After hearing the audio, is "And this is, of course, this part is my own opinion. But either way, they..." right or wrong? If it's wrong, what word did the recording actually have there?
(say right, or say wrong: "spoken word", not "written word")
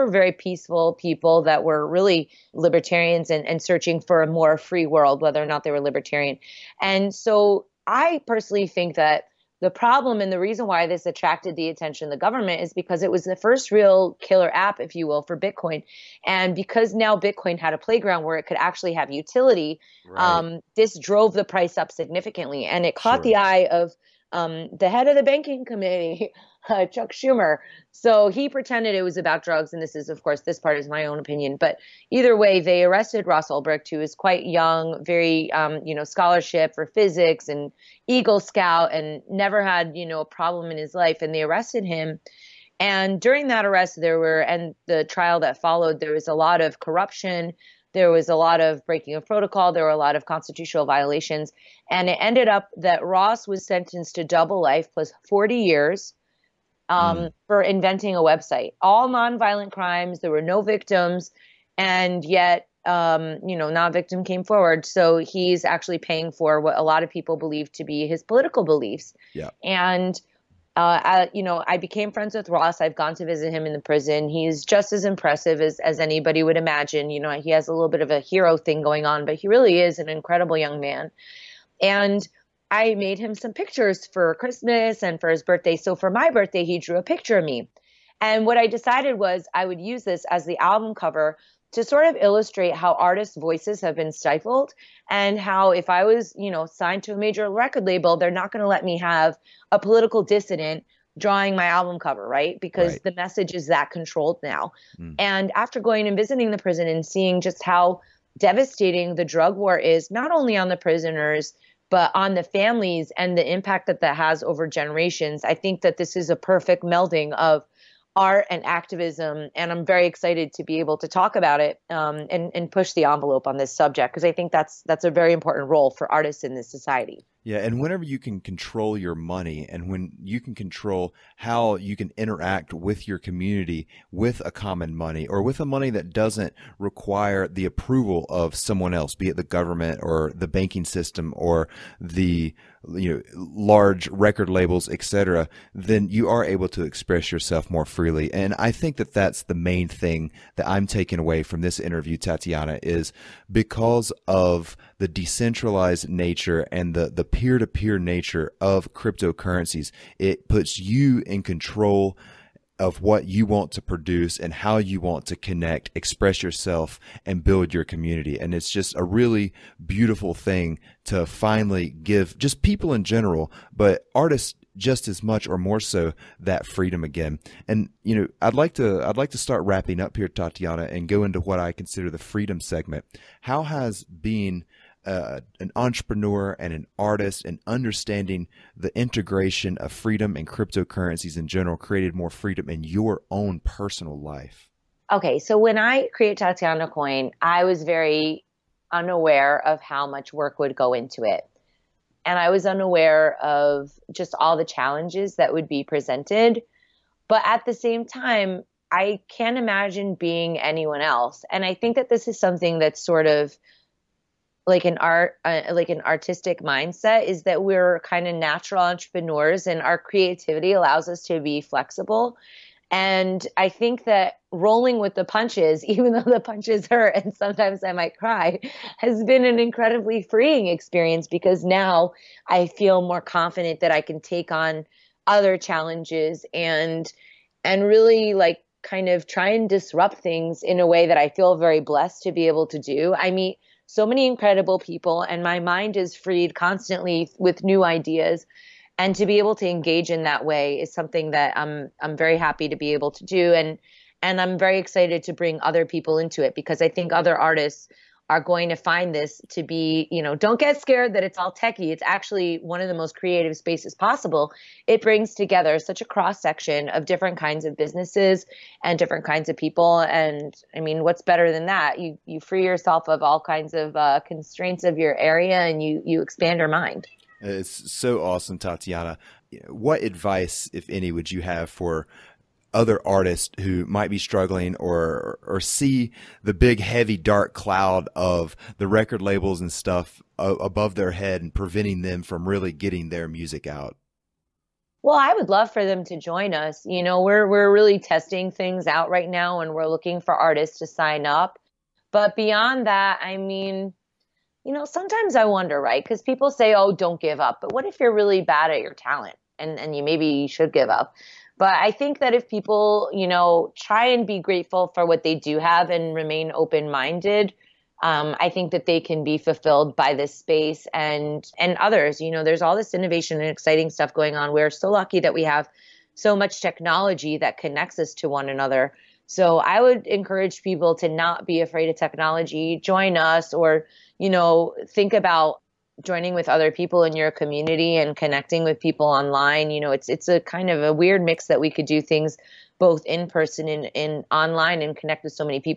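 right.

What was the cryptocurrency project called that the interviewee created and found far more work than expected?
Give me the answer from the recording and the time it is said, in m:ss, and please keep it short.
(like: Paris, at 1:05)
Tatiana Coin, at 3:16.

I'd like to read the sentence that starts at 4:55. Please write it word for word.
Well, I would love for them to join us.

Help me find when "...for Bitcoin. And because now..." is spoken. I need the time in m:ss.
0:15.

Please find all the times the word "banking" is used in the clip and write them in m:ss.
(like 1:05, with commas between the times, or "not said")
0:25, 2:20.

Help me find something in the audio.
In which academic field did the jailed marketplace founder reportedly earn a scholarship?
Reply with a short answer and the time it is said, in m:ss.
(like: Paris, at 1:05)
Physics, at 0:36.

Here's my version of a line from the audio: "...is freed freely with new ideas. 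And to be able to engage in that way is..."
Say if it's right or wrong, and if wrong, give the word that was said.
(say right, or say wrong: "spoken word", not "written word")
wrong: "constantly", not "freely".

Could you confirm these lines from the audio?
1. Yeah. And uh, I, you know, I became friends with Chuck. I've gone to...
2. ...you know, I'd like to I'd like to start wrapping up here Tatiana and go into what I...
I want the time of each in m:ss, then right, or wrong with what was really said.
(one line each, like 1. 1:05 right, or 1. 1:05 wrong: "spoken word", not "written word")
1. 1:09 wrong: "Ross", not "Chuck"
2. 2:58 right.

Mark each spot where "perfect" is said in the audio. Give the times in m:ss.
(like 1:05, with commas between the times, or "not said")
1:56.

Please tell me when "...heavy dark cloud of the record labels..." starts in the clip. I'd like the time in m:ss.
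4:46.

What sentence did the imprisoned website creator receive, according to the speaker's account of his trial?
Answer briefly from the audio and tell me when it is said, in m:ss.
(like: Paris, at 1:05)
double life plus 40 years, at 0:54.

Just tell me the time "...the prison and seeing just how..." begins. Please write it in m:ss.
1:46.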